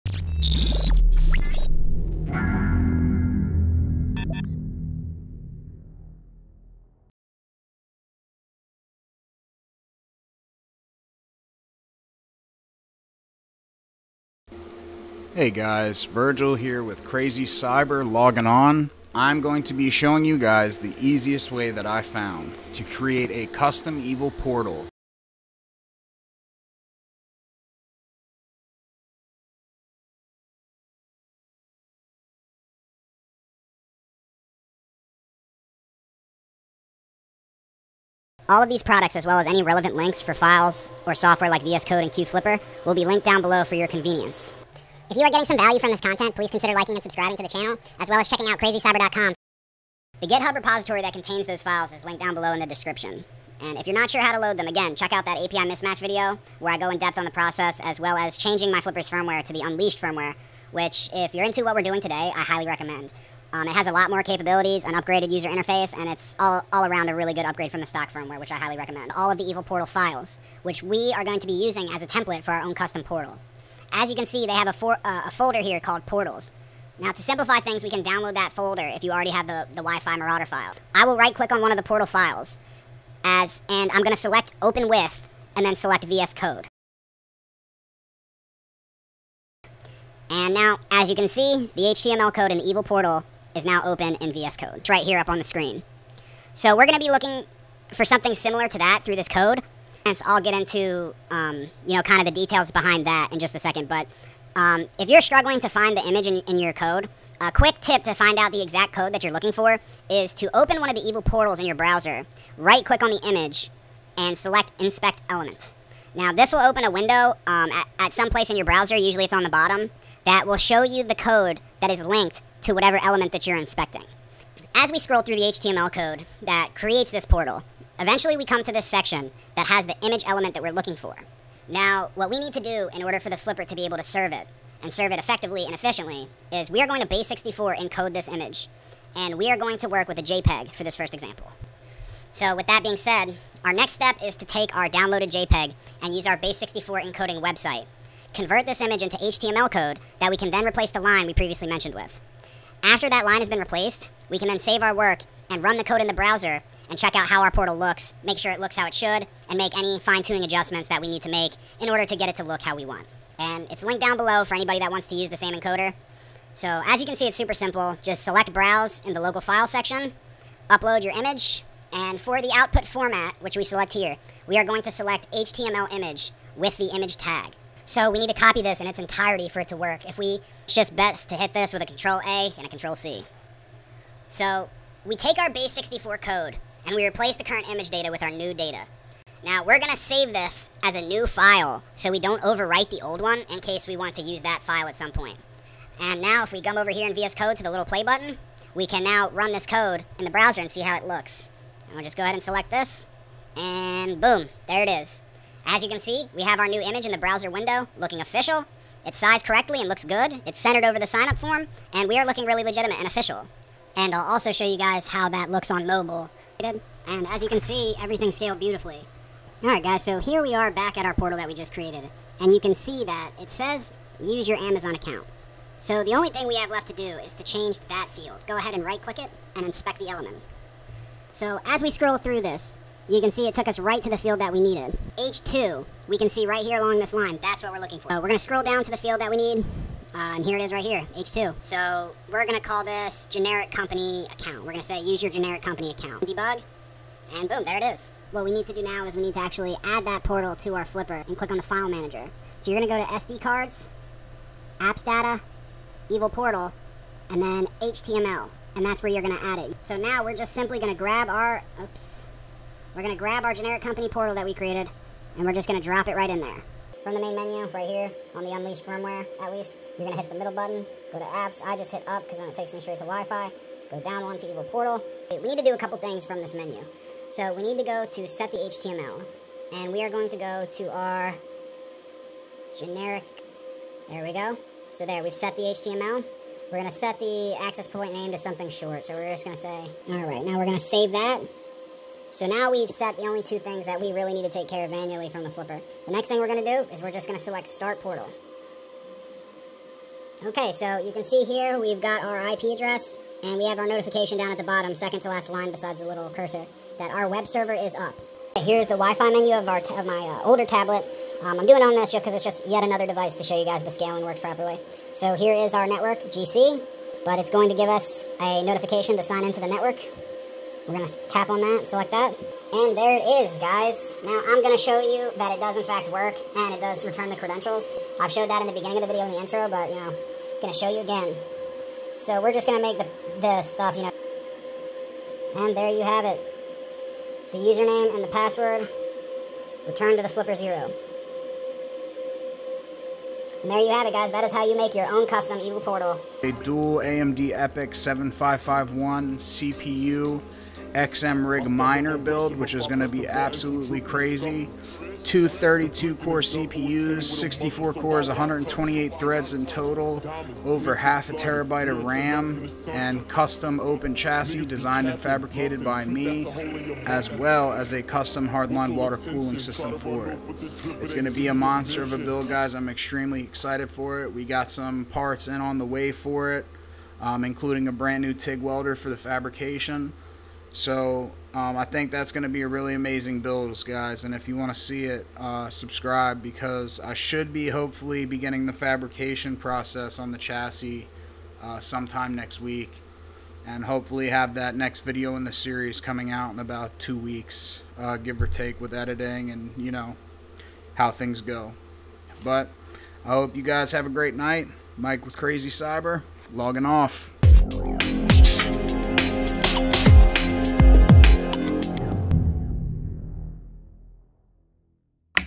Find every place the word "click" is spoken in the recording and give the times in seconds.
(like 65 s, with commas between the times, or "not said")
81 s, 112 s, 229 s, 251 s.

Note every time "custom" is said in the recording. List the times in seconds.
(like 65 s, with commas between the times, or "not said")
23 s, 72 s, 345 s, 363 s, 368 s.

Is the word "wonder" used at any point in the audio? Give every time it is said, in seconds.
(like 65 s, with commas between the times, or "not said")
not said.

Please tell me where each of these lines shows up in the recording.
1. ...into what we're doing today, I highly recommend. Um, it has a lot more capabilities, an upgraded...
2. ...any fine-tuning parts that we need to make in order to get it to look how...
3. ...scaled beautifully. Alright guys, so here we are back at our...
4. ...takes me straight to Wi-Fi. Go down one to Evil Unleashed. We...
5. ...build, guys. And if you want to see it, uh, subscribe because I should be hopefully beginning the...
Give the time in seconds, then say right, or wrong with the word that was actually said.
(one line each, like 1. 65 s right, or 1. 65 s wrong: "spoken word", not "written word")
1. 61 s right
2. 159 s wrong: "adjustments", not "parts"
3. 218 s right
4. 272 s wrong: "Portal", not "Unleashed"
5. 383 s right.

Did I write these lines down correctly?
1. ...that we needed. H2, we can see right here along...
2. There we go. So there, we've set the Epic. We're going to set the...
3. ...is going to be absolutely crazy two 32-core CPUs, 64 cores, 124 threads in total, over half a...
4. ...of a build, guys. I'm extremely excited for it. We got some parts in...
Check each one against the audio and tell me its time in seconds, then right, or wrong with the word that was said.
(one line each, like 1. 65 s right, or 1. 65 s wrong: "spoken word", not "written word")
1. 234 s right
2. 284 s wrong: "HTML", not "Epic"
3. 352 s wrong: "128", not "124"
4. 372 s right.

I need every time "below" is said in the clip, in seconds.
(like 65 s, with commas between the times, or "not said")
43 s, 52 s, 164 s.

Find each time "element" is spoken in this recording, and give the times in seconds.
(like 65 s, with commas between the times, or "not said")
115 s, 123 s, 130 s, 230 s.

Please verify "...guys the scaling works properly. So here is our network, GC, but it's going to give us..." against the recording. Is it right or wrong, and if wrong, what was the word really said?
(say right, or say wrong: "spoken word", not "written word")
right.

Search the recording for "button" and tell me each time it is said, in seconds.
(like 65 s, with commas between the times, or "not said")
198 s, 270 s.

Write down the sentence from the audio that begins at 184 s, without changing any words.
So we take our base64 code, and we replace the current image data with our new data.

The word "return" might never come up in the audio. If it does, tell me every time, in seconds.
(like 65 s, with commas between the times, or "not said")
327 s, 339 s.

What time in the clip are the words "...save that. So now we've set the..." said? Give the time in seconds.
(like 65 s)
290 s.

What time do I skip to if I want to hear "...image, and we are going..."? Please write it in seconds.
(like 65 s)
138 s.